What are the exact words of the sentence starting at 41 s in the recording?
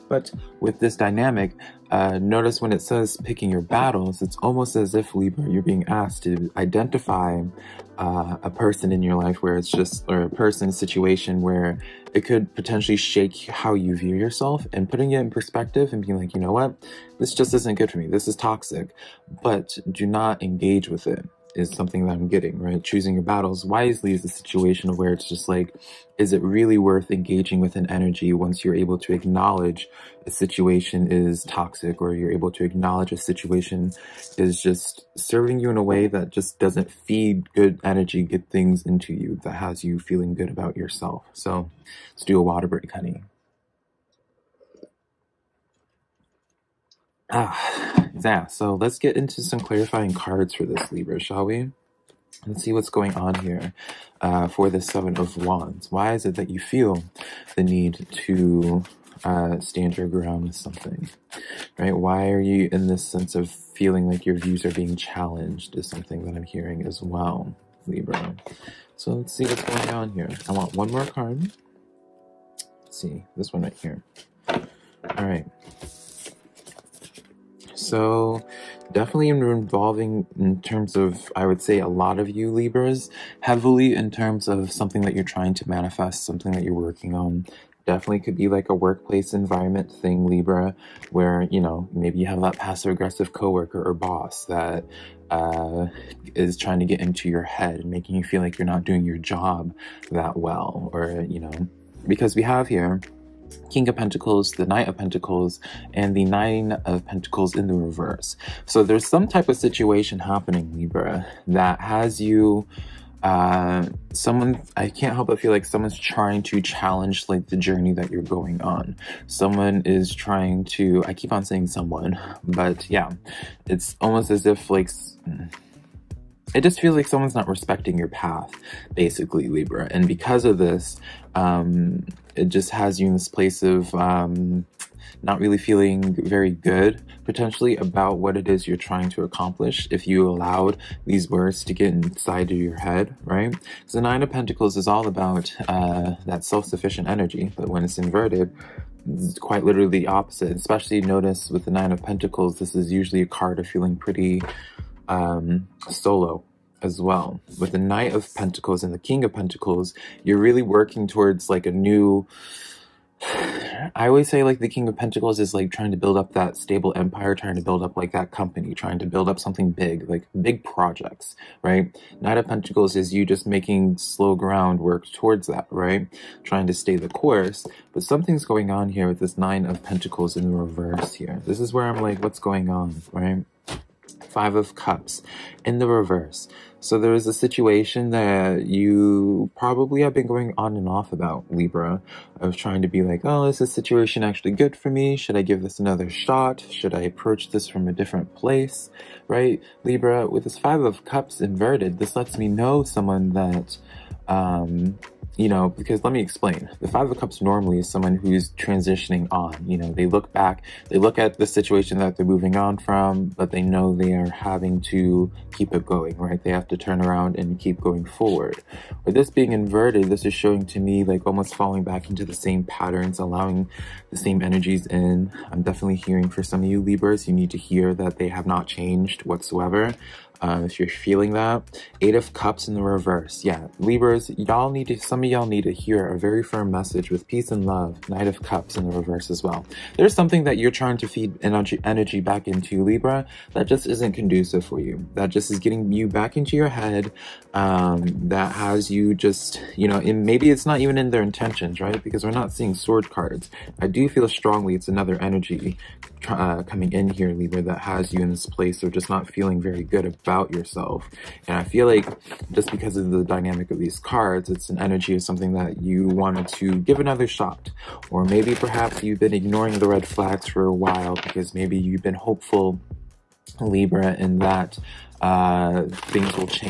So let's do a water break, honey.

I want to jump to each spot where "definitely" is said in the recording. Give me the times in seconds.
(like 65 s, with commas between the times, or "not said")
78 s, 87 s, 225 s.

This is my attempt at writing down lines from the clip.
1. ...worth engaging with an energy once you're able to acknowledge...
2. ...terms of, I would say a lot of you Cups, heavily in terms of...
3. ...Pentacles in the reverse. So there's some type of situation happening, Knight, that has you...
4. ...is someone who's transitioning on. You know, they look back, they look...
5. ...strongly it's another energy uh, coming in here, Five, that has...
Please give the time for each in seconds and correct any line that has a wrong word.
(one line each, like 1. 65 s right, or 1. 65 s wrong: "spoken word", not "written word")
1. 26 s right
2. 80 s wrong: "Libras", not "Cups"
3. 107 s wrong: "Libra", not "Knight"
4. 207 s right
5. 254 s wrong: "Libra", not "Five".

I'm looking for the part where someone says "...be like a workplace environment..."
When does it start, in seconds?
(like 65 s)
88 s.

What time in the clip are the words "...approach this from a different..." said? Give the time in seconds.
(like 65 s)
197 s.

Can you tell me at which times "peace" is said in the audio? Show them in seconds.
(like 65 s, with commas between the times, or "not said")
237 s.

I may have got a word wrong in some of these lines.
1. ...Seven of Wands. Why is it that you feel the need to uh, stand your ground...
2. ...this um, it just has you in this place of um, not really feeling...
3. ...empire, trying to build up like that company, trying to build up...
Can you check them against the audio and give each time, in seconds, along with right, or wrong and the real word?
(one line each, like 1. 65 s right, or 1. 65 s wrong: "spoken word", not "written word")
1. 54 s right
2. 130 s right
3. 166 s right.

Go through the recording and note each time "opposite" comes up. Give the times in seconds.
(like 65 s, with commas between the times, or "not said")
150 s.